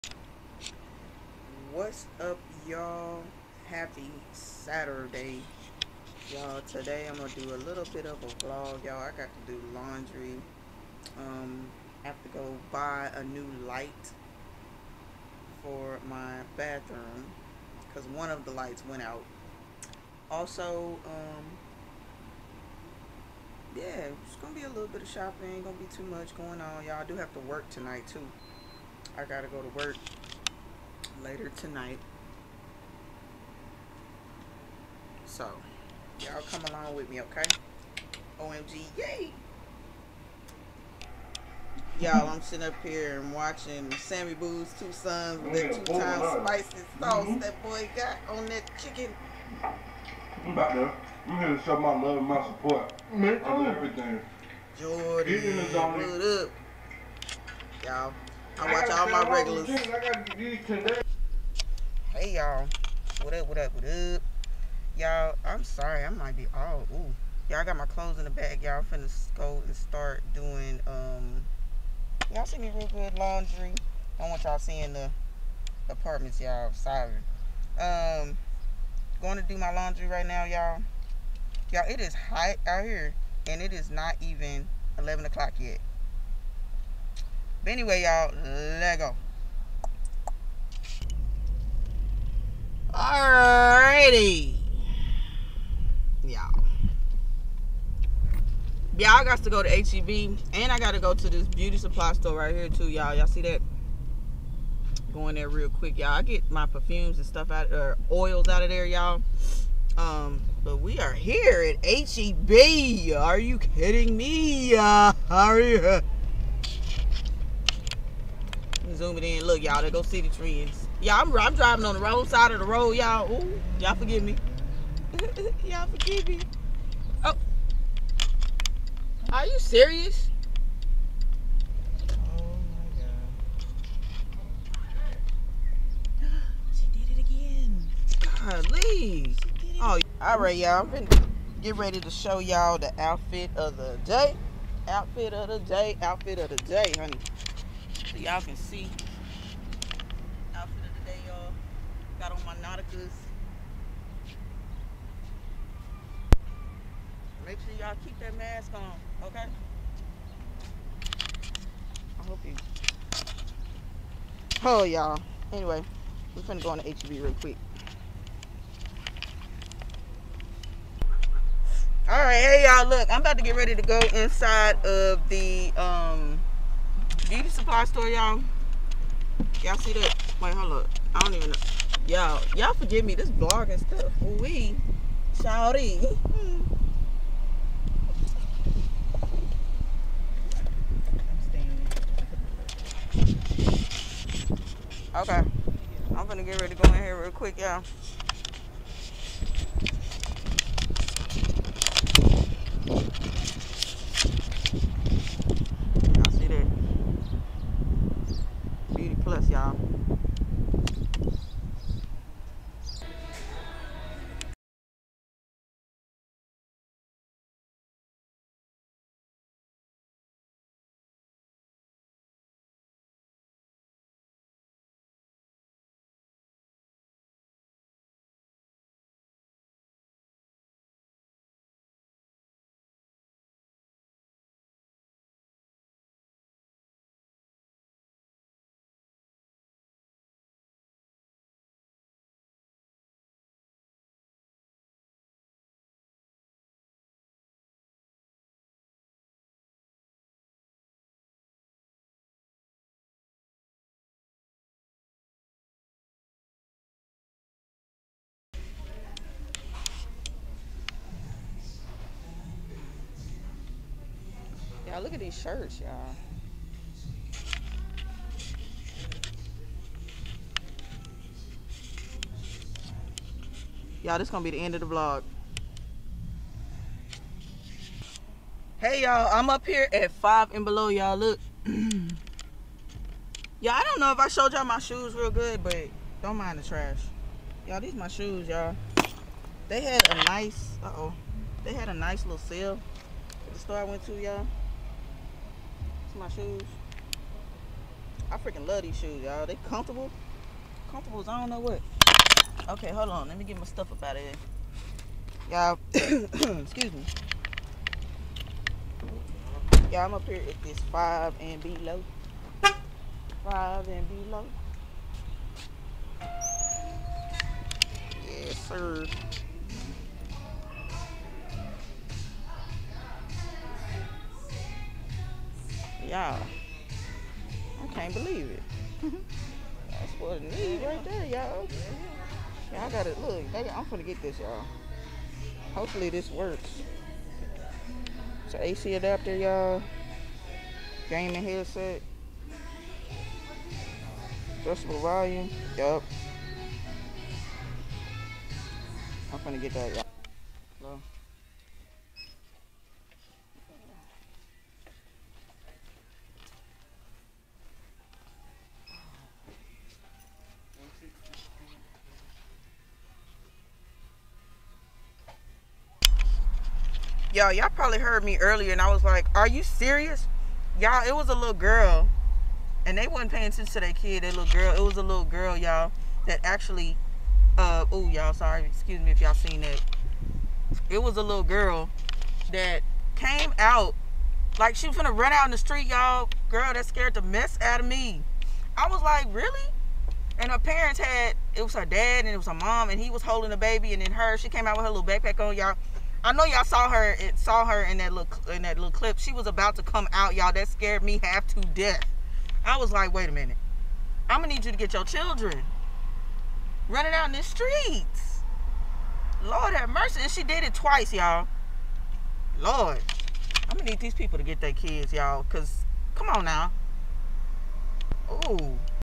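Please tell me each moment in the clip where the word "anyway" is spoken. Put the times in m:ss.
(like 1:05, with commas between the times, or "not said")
1:27, 2:45.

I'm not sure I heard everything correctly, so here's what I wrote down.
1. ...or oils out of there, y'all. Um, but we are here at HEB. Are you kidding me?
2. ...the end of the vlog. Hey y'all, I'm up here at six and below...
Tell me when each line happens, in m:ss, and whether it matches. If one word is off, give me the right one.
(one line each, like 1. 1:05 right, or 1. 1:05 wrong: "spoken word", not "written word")
1. 1:47 right
2. 4:34 wrong: "five", not "six".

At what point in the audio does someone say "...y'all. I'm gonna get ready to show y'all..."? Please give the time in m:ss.
2:20.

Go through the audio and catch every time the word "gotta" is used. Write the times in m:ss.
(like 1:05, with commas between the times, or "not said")
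0:29, 5:32.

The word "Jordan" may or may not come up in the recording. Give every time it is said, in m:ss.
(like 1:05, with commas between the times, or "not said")
0:54.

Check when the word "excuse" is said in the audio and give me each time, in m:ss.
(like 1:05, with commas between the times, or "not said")
5:06, 6:18.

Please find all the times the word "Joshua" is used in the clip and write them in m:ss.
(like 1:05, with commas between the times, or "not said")
not said.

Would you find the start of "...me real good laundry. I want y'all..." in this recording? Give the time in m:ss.
1:12.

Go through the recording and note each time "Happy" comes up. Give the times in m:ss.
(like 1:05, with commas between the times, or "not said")
0:03.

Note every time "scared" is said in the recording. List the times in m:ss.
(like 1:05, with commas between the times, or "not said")
6:26, 6:40.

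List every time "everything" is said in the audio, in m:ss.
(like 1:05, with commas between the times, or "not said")
0:53.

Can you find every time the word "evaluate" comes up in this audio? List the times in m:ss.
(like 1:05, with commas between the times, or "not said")
not said.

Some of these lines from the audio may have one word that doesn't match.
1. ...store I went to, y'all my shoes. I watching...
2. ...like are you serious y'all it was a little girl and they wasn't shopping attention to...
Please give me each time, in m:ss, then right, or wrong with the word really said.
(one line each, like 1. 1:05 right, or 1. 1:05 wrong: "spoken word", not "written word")
1. 4:53 wrong: "freaking", not "watching"
2. 6:09 wrong: "paying", not "shopping".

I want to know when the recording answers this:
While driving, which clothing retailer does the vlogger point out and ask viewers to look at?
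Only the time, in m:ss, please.
2:00.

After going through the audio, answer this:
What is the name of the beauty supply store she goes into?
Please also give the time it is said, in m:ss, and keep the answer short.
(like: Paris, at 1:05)
Beauty Plus, at 3:28.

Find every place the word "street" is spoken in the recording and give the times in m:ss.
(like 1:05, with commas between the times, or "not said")
6:25, 6:47.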